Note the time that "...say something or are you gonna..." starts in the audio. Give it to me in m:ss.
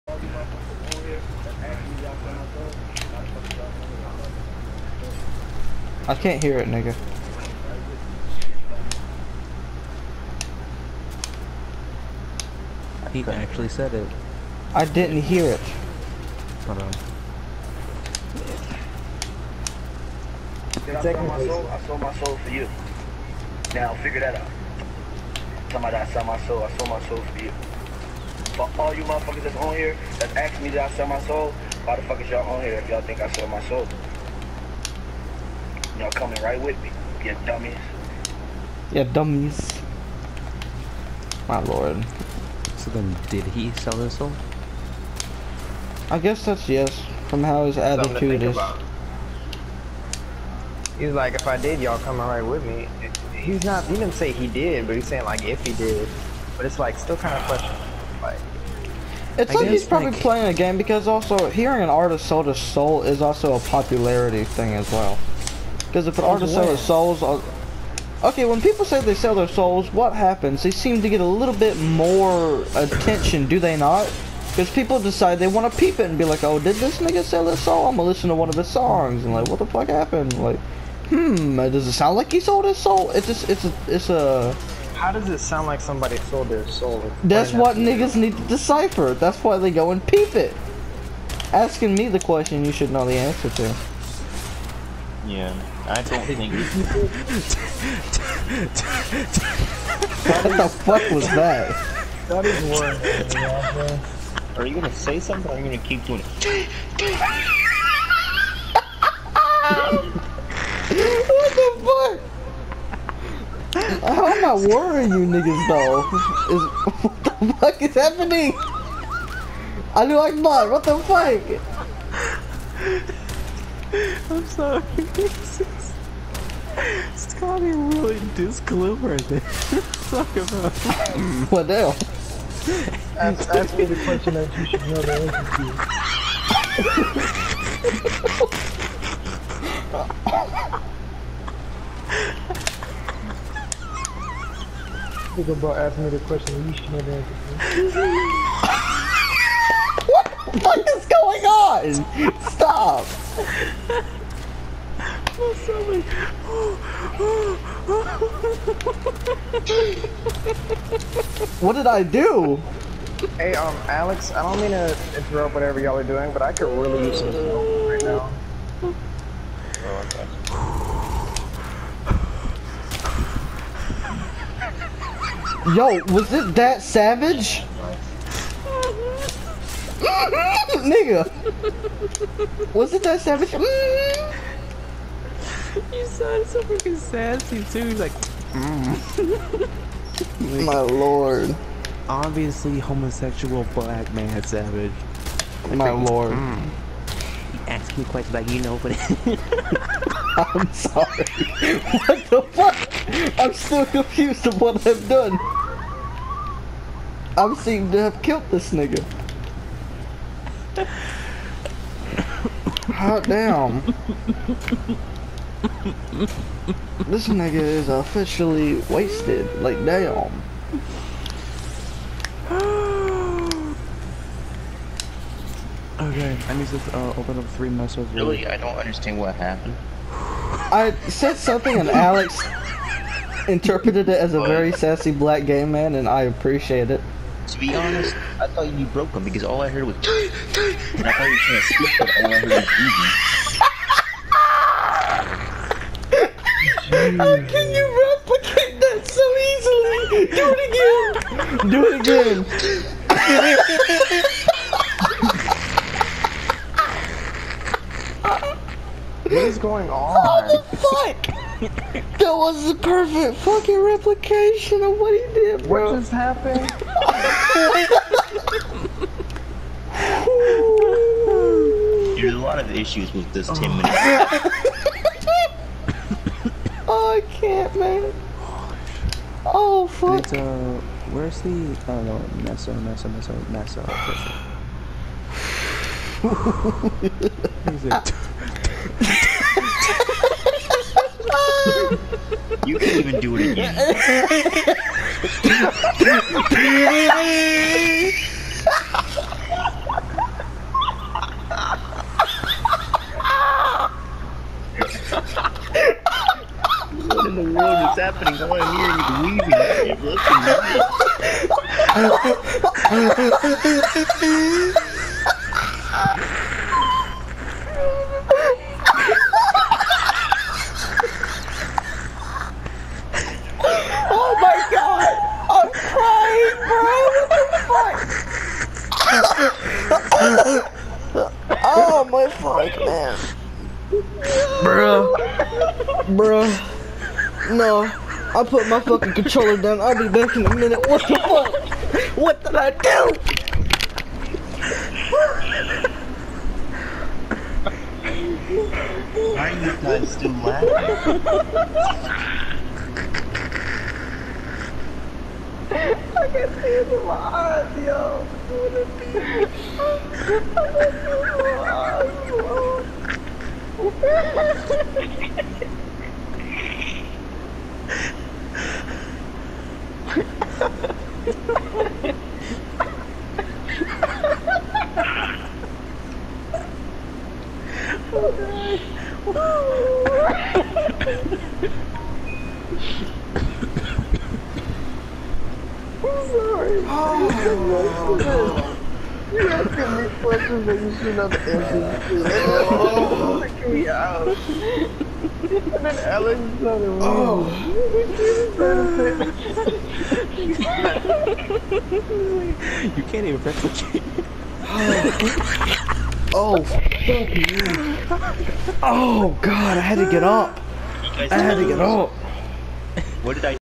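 1:44.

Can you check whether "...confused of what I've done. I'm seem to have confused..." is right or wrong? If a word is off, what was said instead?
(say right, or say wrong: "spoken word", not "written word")
wrong: "killed", not "confused".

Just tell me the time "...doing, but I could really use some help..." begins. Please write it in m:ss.
2:46.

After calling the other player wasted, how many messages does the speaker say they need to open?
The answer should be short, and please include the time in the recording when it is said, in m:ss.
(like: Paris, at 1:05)
3, at 3:47.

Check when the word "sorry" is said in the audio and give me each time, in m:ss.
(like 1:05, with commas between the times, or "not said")
2:04, 3:20.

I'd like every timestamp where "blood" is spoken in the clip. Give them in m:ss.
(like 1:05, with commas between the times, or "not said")
2:00.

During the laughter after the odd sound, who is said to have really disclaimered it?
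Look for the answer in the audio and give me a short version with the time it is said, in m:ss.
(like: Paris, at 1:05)
Scotty, at 2:07.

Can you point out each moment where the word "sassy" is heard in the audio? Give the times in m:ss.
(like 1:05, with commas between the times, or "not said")
3:06, 3:54.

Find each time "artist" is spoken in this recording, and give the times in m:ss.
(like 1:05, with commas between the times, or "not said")
1:01, 1:06.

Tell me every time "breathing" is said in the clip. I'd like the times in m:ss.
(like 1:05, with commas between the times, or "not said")
4:06.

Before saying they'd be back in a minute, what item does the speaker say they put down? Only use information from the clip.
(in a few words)
Controller.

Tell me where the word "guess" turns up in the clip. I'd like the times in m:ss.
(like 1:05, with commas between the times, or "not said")
0:46.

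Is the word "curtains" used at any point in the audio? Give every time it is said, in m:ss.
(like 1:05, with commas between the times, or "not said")
not said.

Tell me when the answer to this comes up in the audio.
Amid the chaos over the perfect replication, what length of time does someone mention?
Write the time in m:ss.
4:33.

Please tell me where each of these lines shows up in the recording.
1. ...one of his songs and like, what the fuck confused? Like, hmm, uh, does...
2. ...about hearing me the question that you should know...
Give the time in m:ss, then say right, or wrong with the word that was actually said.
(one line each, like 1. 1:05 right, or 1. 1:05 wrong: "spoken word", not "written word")
1. 1:18 wrong: "happened", not "confused"
2. 2:25 wrong: "asking", not "hearing".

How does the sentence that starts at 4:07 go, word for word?
How can you replicate that so easily?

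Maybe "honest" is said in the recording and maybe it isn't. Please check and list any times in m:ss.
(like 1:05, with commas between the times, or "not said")
3:57.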